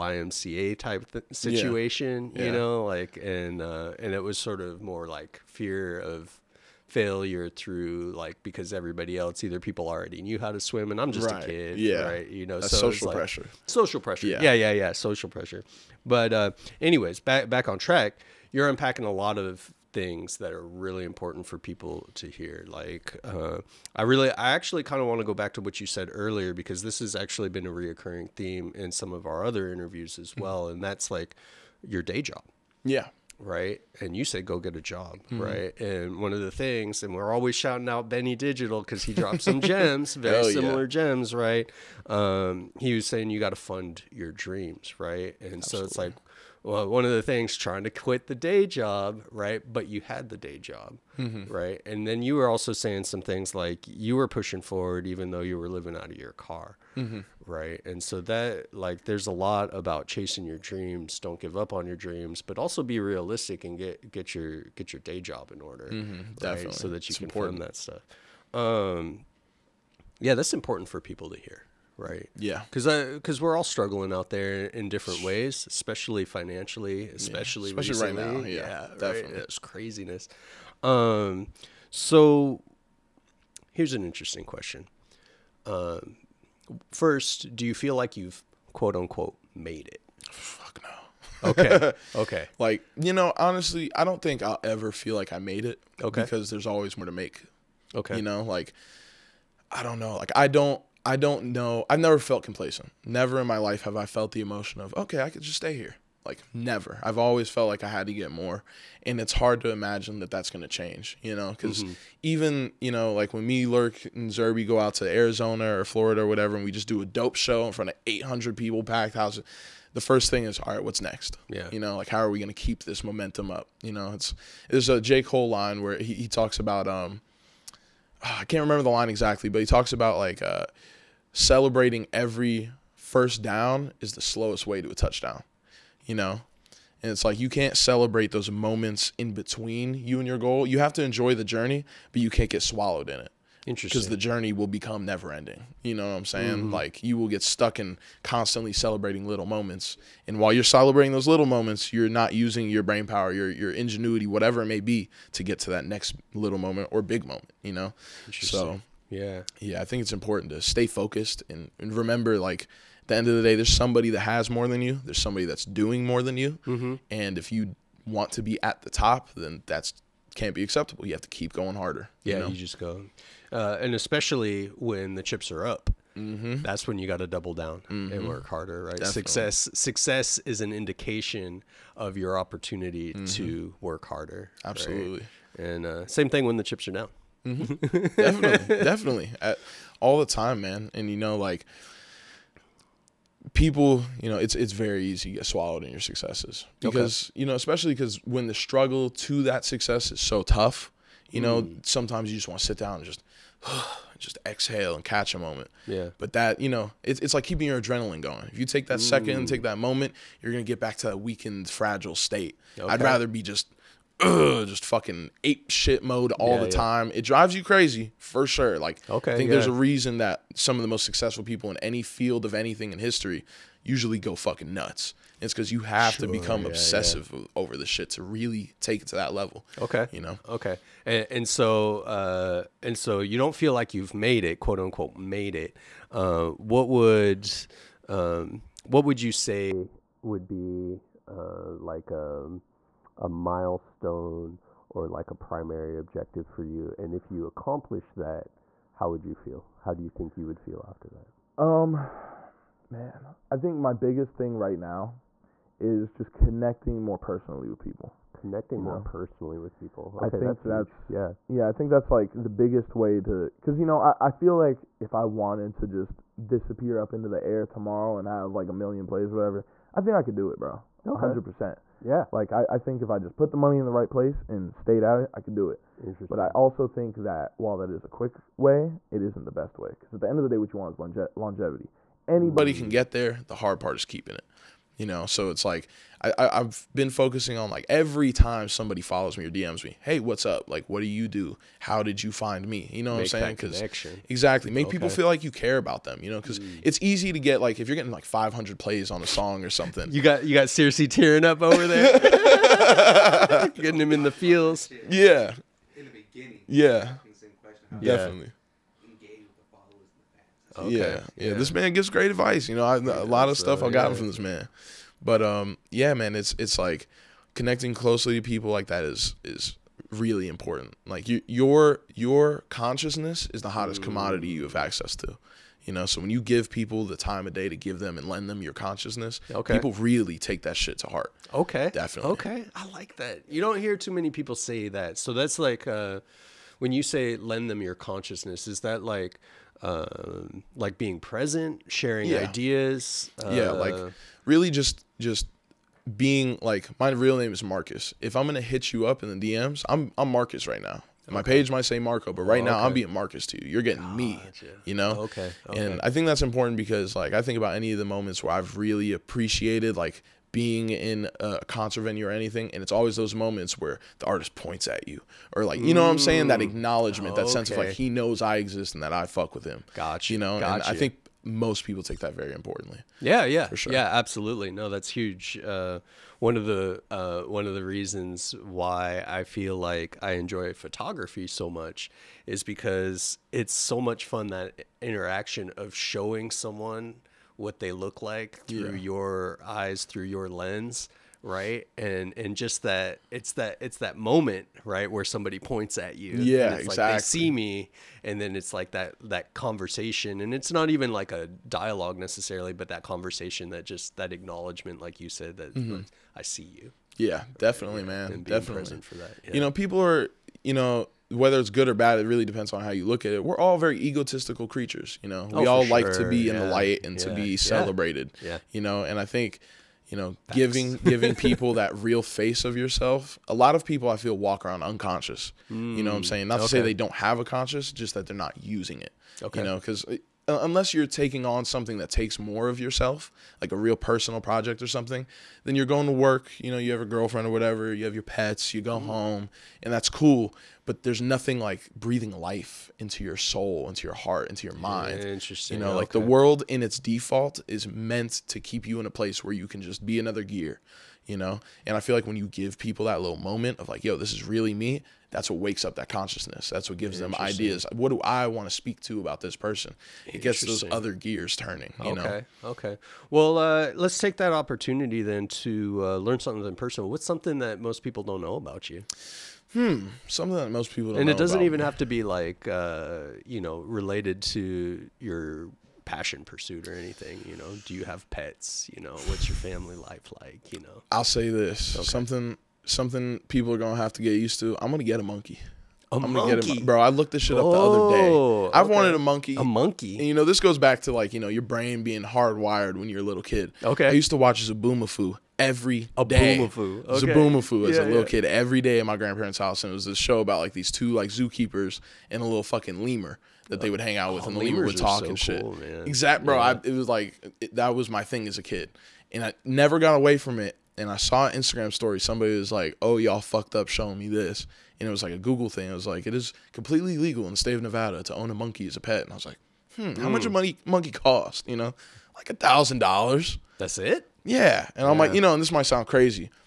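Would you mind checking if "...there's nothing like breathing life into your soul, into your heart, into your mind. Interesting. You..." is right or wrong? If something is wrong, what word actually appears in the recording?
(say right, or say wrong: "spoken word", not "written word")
right.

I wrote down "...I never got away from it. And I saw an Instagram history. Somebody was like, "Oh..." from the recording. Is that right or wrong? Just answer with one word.
wrong.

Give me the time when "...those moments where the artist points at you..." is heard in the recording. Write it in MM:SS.
06:03.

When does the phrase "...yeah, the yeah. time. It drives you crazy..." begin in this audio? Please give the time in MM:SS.
03:36.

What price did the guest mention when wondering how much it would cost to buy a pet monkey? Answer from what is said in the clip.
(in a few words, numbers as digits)
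$1,000.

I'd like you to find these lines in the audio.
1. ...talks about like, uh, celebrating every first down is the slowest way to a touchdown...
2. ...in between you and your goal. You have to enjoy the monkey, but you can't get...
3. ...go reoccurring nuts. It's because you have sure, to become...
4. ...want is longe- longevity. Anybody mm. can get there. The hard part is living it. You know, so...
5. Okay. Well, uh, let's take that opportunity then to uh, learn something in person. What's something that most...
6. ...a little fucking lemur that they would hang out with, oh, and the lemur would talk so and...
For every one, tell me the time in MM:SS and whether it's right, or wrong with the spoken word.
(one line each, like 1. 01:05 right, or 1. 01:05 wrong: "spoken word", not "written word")
1. 02:09 right
2. 02:19 wrong: "journey", not "monkey"
3. 03:44 wrong: "fucking", not "reoccurring"
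4. 04:40 wrong: "keeping", not "living"
5. 07:42 right
6. 08:22 right.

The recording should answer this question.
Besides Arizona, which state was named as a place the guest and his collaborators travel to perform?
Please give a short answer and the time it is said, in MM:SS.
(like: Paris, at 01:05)
Florida, at 01:55.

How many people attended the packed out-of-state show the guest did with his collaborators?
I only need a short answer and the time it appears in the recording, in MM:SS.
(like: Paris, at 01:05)
800, at 01:58.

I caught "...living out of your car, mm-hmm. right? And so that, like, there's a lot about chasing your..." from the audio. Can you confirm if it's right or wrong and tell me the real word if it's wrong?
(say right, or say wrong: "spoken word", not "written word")
right.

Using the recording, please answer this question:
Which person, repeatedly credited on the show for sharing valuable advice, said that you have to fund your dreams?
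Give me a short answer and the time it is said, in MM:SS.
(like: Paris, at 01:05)
Benny Digital, at 00:38.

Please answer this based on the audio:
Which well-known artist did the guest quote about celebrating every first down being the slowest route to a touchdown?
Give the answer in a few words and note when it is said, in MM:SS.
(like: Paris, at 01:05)
J. Cole, at 02:04.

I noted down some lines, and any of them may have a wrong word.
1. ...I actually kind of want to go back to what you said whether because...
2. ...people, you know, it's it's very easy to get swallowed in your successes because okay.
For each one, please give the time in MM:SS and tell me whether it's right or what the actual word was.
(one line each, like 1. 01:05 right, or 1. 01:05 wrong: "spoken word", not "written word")
1. 00:24 wrong: "earlier", not "whether"
2. 03:13 right.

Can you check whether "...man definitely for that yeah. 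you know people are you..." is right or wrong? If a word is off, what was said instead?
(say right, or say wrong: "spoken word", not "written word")
right.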